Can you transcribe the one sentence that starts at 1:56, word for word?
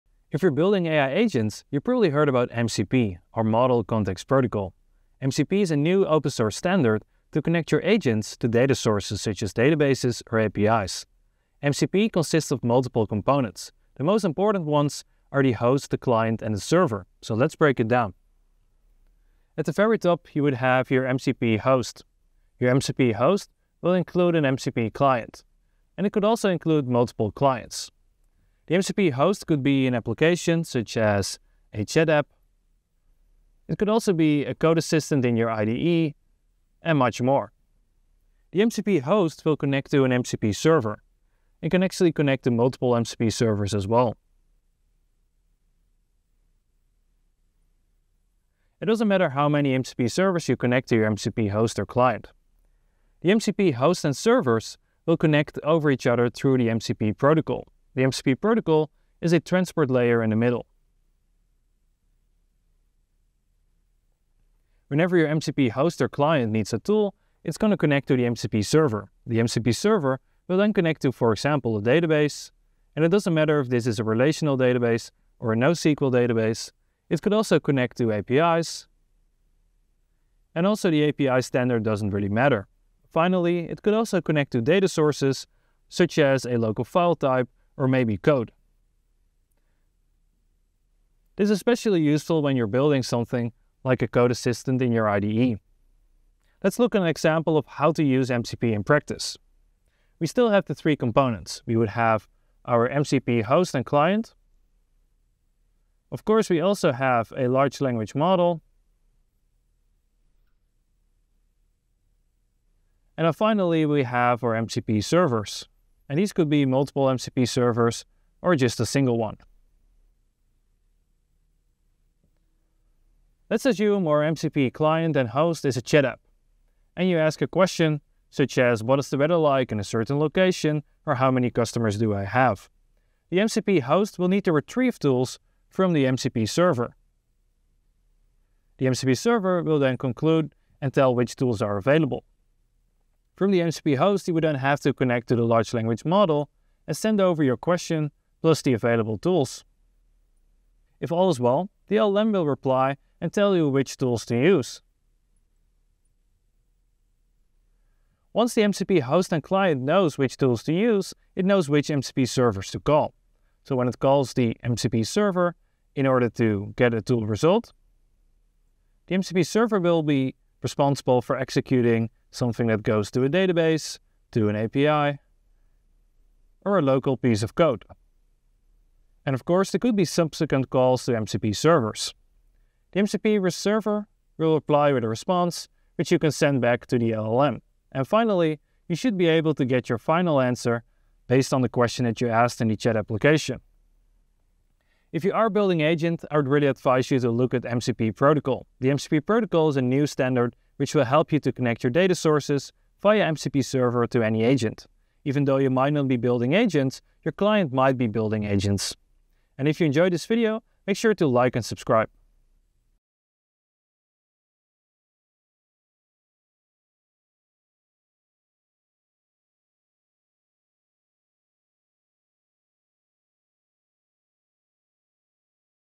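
And these could be multiple MCP servers or just a single one.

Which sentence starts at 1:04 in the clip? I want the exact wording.
Whenever your MCP host or client needs a tool, it's going to connect to the MCP server.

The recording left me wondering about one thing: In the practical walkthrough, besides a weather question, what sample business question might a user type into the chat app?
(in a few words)
how many customers do I have.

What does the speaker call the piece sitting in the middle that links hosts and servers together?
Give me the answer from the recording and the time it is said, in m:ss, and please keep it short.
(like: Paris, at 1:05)
transport layer, at 0:59.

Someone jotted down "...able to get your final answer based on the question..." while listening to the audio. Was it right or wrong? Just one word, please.
right.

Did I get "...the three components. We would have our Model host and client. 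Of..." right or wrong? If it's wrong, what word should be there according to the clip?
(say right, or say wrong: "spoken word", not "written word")
wrong: "MCP", not "Model".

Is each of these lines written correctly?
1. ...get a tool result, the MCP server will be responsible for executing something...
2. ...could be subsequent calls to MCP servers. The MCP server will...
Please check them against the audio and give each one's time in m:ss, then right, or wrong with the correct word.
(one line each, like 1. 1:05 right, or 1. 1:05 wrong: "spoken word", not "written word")
1. 2:46 right
2. 2:59 right.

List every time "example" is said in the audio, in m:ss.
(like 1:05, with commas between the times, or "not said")
1:11, 1:37.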